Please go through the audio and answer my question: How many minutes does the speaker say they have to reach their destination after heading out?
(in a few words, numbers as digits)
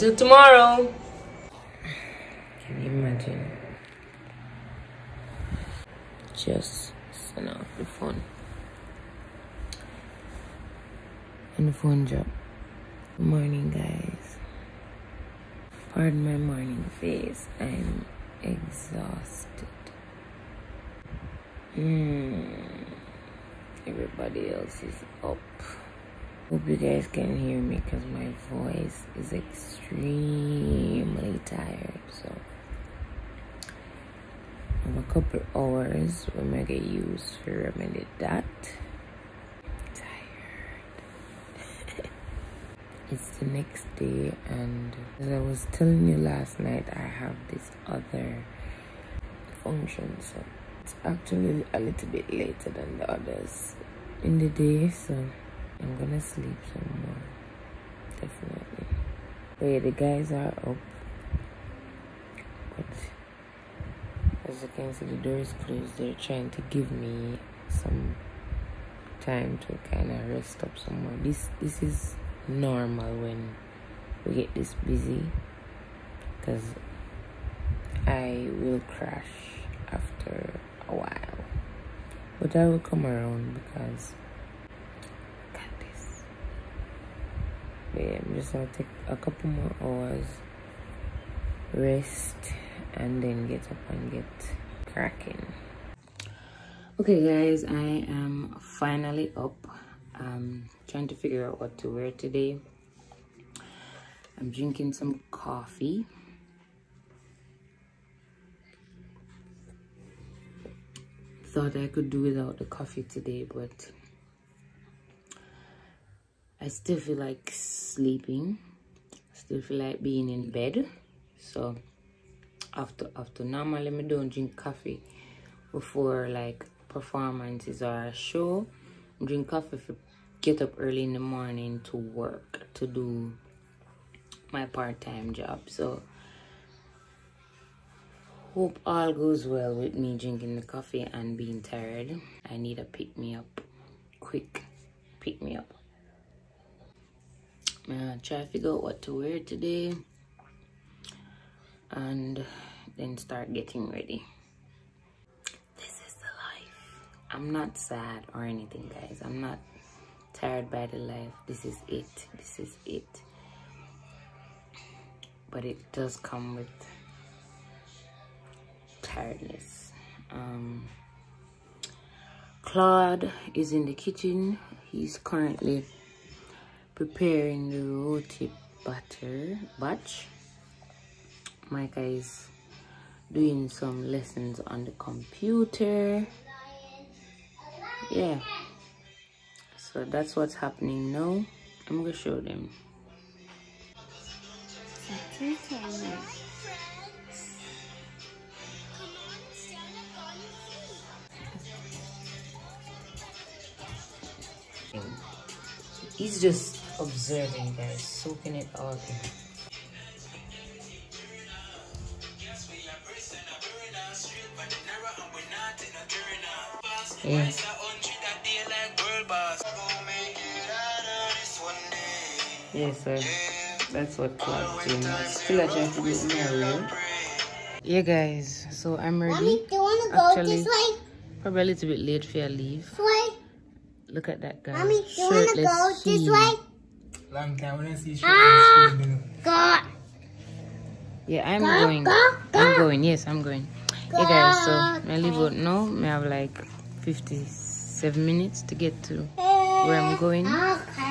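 57.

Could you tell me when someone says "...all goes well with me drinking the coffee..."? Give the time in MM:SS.
02:18.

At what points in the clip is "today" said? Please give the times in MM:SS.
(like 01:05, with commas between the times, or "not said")
01:42, 01:53, 02:29.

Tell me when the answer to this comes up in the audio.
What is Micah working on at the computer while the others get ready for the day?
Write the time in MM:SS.
03:04.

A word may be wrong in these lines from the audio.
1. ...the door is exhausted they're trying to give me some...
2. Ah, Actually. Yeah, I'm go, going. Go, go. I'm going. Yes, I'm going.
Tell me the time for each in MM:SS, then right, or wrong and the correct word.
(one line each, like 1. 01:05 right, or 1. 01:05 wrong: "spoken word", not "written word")
1. 01:05 wrong: "closed", not "exhausted"
2. 03:58 wrong: "God", not "Actually".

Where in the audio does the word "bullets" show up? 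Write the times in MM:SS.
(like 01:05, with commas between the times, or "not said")
not said.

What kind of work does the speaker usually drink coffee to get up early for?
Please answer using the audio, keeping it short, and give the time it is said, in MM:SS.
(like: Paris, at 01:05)
part-time job, at 02:14.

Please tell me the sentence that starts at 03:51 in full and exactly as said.
Probably a little bit late for your leave.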